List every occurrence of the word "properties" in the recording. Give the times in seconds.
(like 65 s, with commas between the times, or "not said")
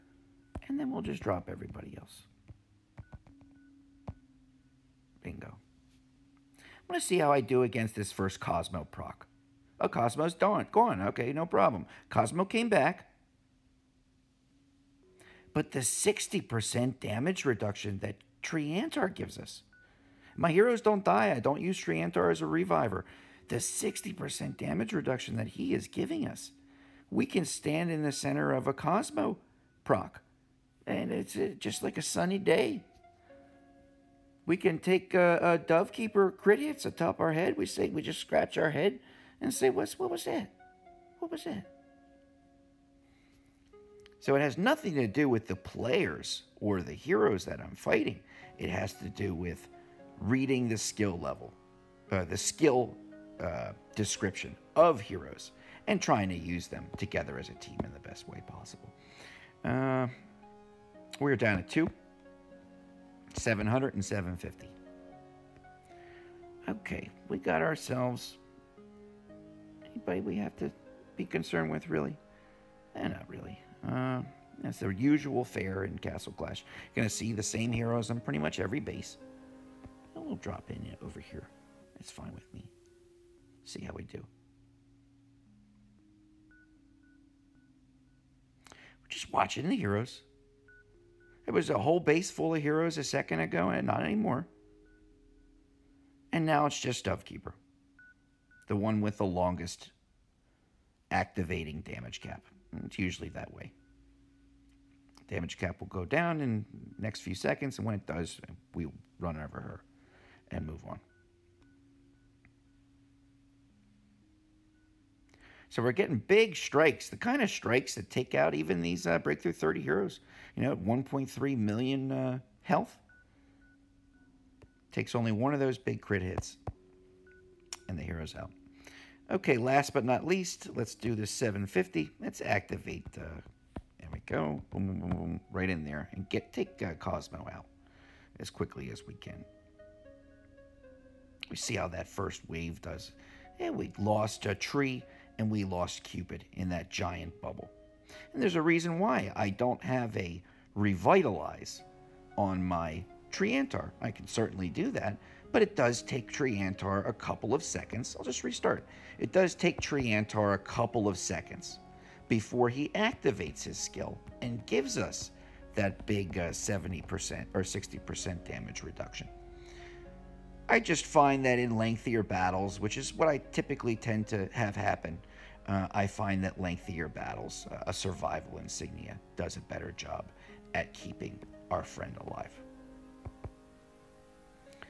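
not said.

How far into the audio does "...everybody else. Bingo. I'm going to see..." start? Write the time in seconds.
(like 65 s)
1 s.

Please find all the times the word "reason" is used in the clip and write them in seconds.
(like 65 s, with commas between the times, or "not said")
148 s.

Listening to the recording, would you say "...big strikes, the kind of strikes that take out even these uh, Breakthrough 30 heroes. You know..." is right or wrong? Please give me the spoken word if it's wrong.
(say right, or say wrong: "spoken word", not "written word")
right.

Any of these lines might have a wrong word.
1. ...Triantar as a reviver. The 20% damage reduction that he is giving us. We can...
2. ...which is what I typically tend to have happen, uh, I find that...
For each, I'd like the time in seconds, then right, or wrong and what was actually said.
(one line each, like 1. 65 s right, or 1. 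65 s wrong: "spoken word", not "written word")
1. 21 s wrong: "60", not "20"
2. 172 s right.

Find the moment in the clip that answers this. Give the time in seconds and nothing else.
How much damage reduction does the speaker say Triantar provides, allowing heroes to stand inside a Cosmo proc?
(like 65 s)
15 s.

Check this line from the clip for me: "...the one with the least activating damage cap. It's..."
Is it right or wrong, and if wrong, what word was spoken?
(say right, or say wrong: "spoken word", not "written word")
wrong: "longest", not "least".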